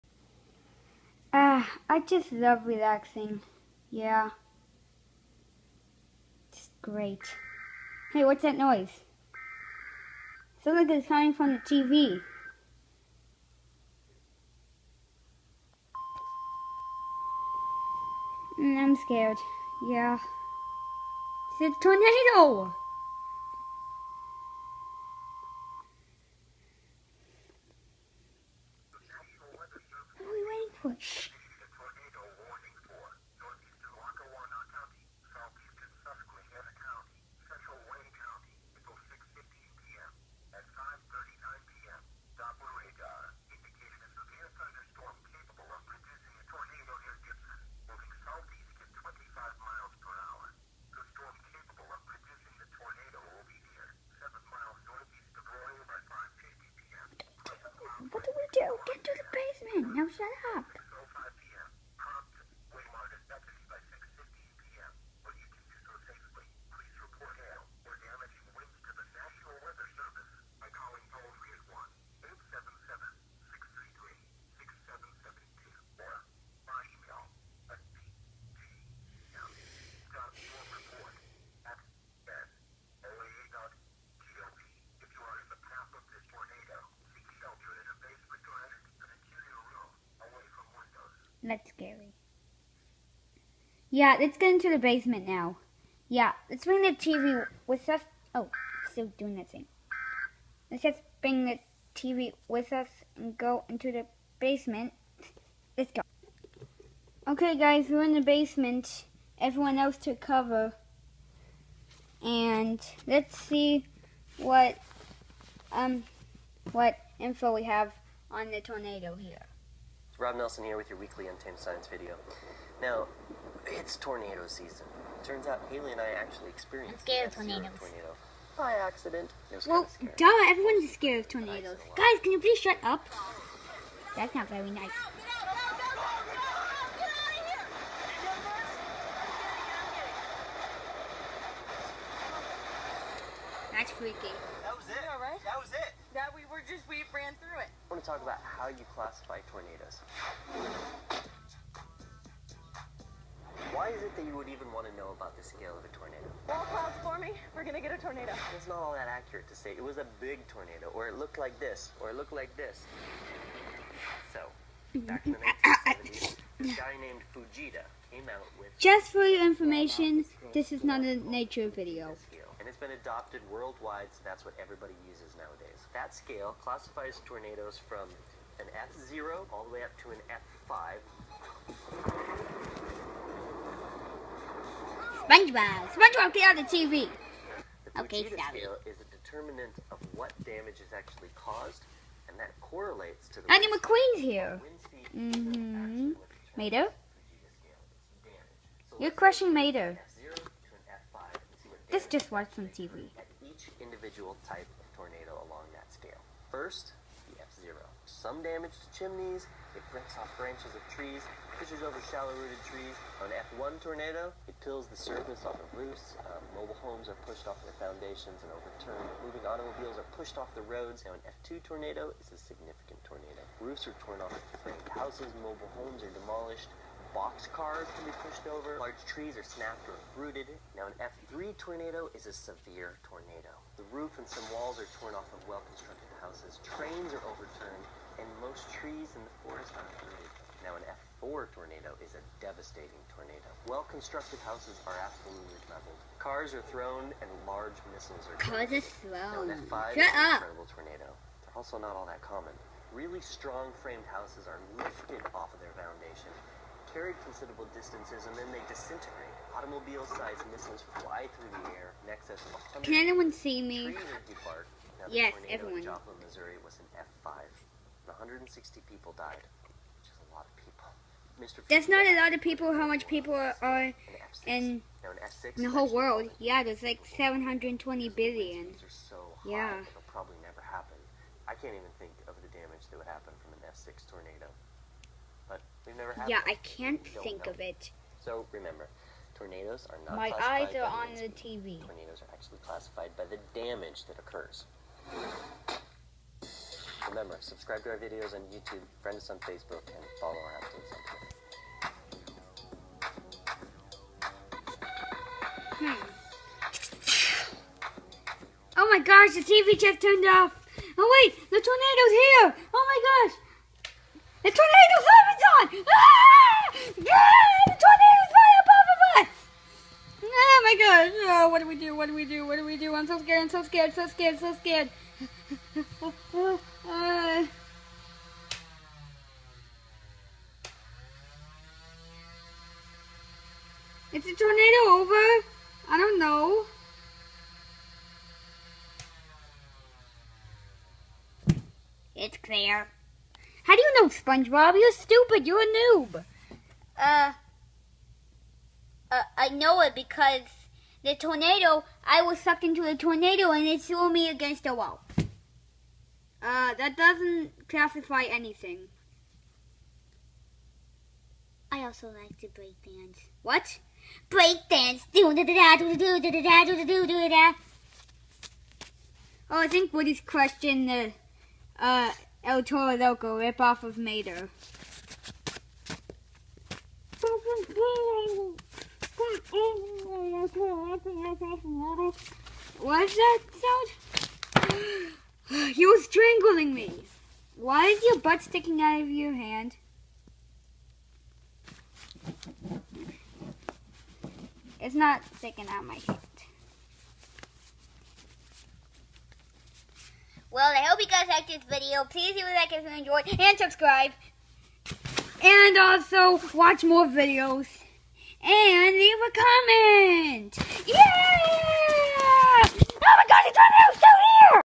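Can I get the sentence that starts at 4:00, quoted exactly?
Now, an F4 tornado is a devastating tornado.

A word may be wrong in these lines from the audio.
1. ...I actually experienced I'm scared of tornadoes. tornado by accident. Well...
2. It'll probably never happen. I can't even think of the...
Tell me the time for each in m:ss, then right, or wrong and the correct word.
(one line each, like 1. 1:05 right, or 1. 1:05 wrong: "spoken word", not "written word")
1. 2:05 right
2. 4:39 right.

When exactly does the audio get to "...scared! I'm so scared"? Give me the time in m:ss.
5:23.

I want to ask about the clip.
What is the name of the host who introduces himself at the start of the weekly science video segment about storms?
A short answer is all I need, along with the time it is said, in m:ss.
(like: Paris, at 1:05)
Rob Nelson, at 2:00.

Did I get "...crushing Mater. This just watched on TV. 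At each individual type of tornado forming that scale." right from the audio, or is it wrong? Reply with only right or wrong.
wrong.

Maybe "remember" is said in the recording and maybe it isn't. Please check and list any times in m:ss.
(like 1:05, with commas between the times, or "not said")
4:48, 4:57.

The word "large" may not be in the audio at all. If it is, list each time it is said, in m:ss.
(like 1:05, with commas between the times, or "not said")
3:48, 4:07.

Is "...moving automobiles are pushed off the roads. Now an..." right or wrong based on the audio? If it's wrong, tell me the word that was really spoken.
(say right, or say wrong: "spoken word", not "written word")
right.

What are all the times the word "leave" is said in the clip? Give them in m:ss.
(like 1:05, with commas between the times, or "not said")
6:42, 6:48.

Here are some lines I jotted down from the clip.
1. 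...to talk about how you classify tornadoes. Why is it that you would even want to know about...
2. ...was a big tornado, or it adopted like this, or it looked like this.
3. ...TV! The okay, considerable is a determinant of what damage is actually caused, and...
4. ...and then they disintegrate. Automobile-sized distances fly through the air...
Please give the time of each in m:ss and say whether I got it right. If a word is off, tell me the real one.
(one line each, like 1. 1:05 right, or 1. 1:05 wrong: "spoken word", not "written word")
1. 2:28 right
2. 2:39 wrong: "looked", not "adopted"
3. 3:06 wrong: "scale", not "considerable"
4. 4:18 wrong: "missiles", not "distances".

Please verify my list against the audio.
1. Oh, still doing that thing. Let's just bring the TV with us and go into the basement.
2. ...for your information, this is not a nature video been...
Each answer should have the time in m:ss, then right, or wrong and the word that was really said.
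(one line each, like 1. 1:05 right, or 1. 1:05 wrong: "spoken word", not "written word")
1. 1:38 right
2. 2:49 right.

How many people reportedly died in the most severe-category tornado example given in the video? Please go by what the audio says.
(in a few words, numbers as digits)
160.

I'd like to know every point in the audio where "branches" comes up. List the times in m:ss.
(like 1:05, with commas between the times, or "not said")
3:30.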